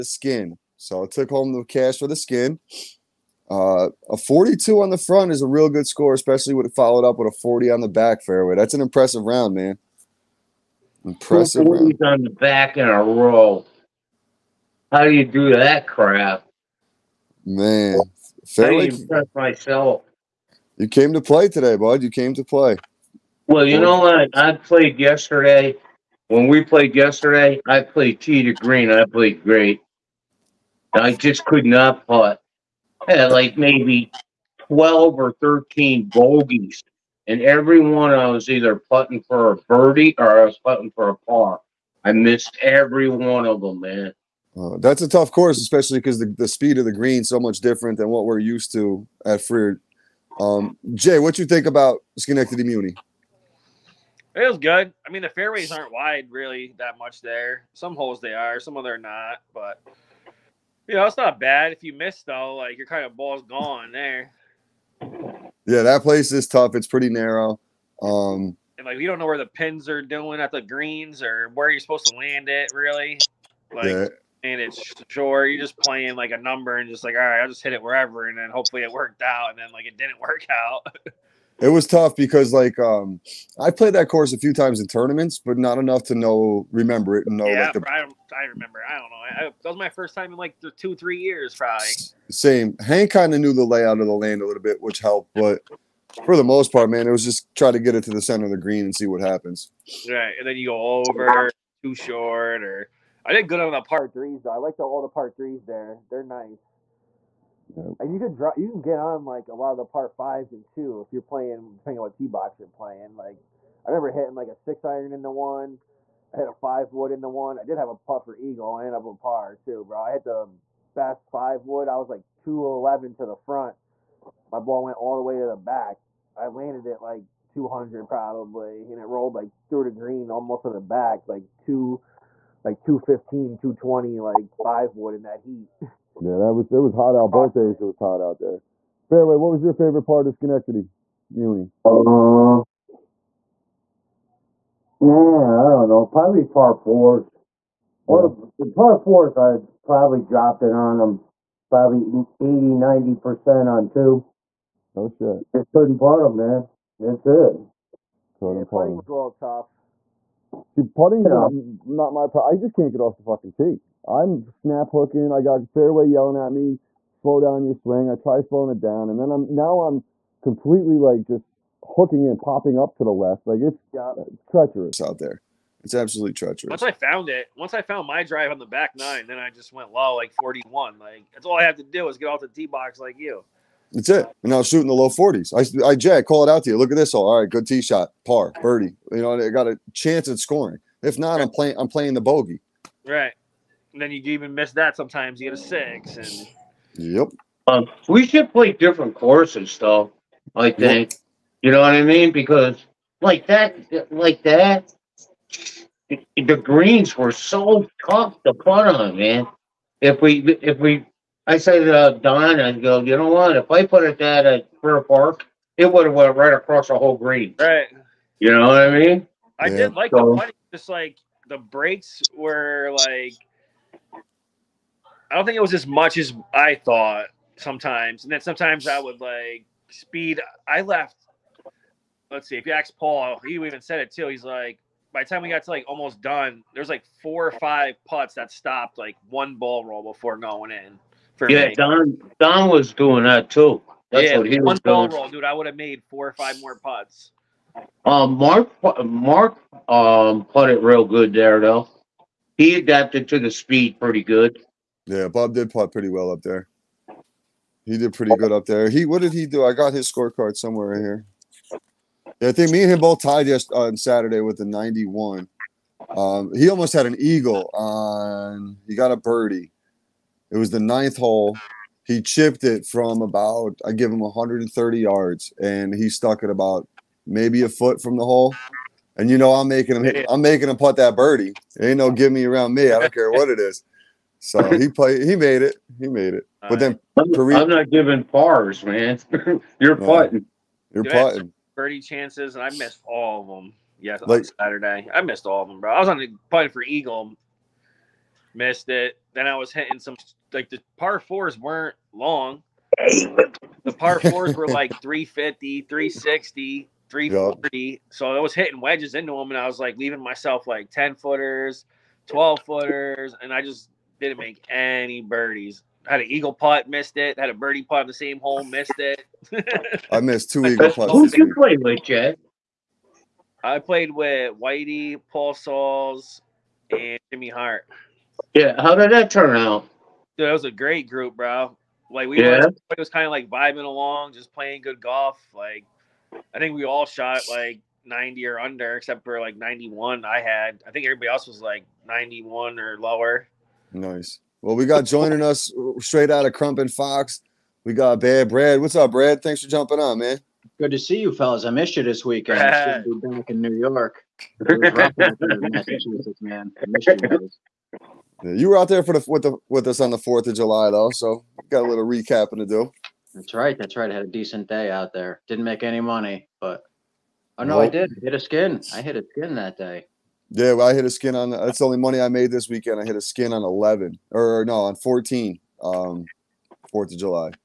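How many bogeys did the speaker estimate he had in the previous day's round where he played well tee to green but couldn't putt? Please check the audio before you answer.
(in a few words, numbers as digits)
12 or 13.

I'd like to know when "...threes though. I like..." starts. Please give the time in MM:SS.
01:44.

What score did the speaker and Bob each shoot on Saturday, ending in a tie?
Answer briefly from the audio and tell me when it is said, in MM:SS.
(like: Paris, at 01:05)
91, at 04:24.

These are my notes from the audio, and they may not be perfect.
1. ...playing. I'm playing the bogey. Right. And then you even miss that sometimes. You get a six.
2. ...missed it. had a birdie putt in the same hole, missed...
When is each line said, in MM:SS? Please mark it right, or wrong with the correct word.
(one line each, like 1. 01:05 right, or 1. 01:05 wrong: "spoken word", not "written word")
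1. 03:11 right
2. 05:16 right.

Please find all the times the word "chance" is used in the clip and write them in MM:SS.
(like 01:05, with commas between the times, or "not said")
03:09, 04:51.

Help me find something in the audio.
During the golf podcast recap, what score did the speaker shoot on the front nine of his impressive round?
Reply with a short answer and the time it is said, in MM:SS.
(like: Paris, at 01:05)
42, at 00:04.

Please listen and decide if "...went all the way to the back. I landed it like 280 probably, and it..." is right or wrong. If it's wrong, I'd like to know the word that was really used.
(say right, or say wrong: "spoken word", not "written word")
wrong: "200", not "280".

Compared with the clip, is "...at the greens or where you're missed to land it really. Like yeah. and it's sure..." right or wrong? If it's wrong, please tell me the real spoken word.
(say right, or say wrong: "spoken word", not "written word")
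wrong: "supposed", not "missed".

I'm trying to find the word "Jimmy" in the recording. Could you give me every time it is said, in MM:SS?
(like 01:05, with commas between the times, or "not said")
05:27.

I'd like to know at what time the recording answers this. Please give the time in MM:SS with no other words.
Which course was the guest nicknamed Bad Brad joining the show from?
05:46.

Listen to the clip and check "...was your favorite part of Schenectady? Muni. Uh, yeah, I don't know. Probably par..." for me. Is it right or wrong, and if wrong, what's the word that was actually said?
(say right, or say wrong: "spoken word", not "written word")
right.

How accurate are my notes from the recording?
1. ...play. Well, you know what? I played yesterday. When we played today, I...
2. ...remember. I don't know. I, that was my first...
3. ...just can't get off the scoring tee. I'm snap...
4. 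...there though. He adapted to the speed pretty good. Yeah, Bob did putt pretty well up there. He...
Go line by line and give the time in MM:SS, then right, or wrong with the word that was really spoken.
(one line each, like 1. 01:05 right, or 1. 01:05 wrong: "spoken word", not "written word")
1. 00:22 wrong: "yesterday", not "today"
2. 01:28 right
3. 02:42 wrong: "fucking", not "scoring"
4. 04:11 right.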